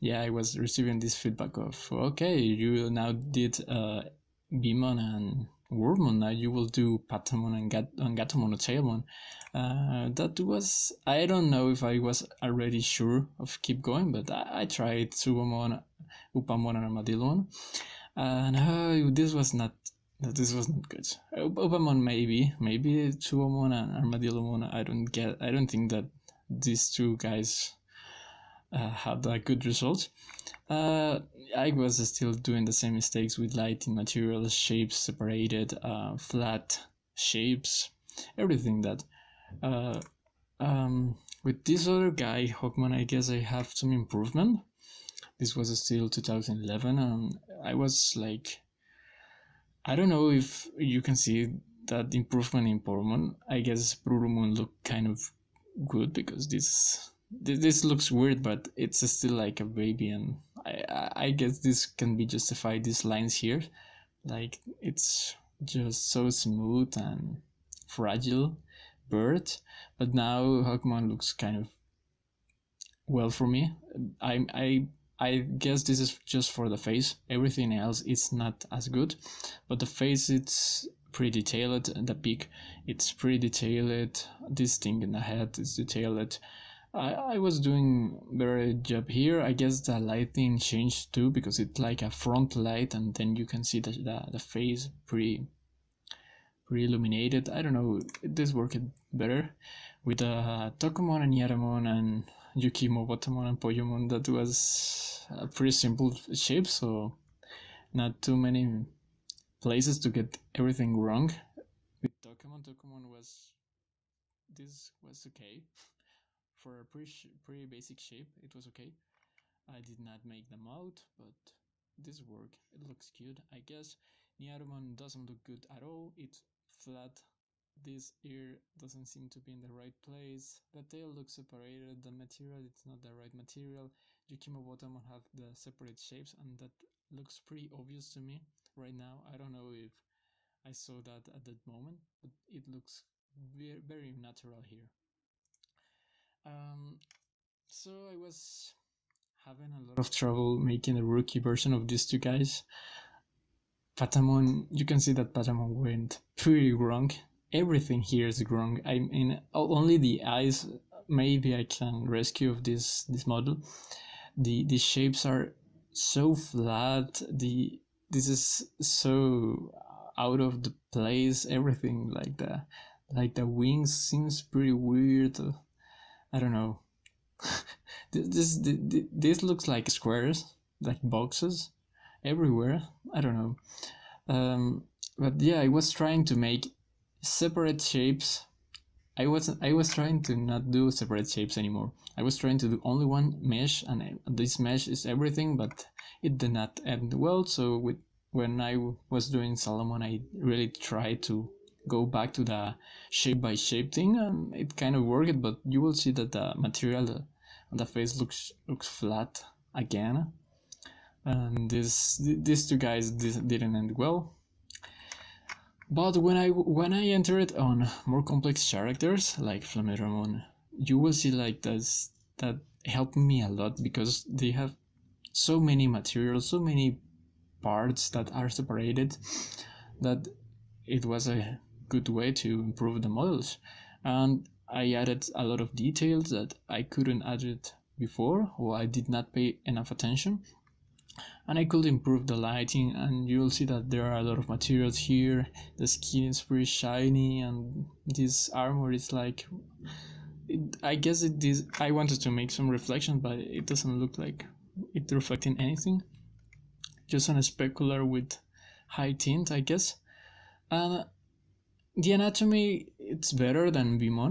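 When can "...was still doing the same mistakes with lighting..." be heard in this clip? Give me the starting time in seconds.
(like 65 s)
31 s.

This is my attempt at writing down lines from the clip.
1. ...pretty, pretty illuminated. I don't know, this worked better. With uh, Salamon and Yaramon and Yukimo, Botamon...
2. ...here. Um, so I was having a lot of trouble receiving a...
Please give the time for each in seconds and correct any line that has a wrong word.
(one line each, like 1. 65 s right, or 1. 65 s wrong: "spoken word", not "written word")
1. 95 s wrong: "Tokomon", not "Salamon"
2. 144 s wrong: "making", not "receiving".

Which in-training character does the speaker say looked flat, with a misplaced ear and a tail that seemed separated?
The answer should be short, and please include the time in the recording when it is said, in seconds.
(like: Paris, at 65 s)
Nyaromon, at 124 s.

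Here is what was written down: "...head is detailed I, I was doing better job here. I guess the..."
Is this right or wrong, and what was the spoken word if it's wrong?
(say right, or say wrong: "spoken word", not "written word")
right.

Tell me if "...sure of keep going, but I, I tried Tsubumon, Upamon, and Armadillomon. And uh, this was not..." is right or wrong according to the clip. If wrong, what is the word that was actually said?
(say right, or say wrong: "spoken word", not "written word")
right.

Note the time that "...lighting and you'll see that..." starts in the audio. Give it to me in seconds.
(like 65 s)
242 s.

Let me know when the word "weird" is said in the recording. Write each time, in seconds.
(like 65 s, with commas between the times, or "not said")
58 s, 174 s.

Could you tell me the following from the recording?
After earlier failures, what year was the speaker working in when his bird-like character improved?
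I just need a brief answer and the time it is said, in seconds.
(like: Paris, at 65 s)
2011, at 46 s.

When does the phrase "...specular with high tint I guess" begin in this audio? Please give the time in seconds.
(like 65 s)
257 s.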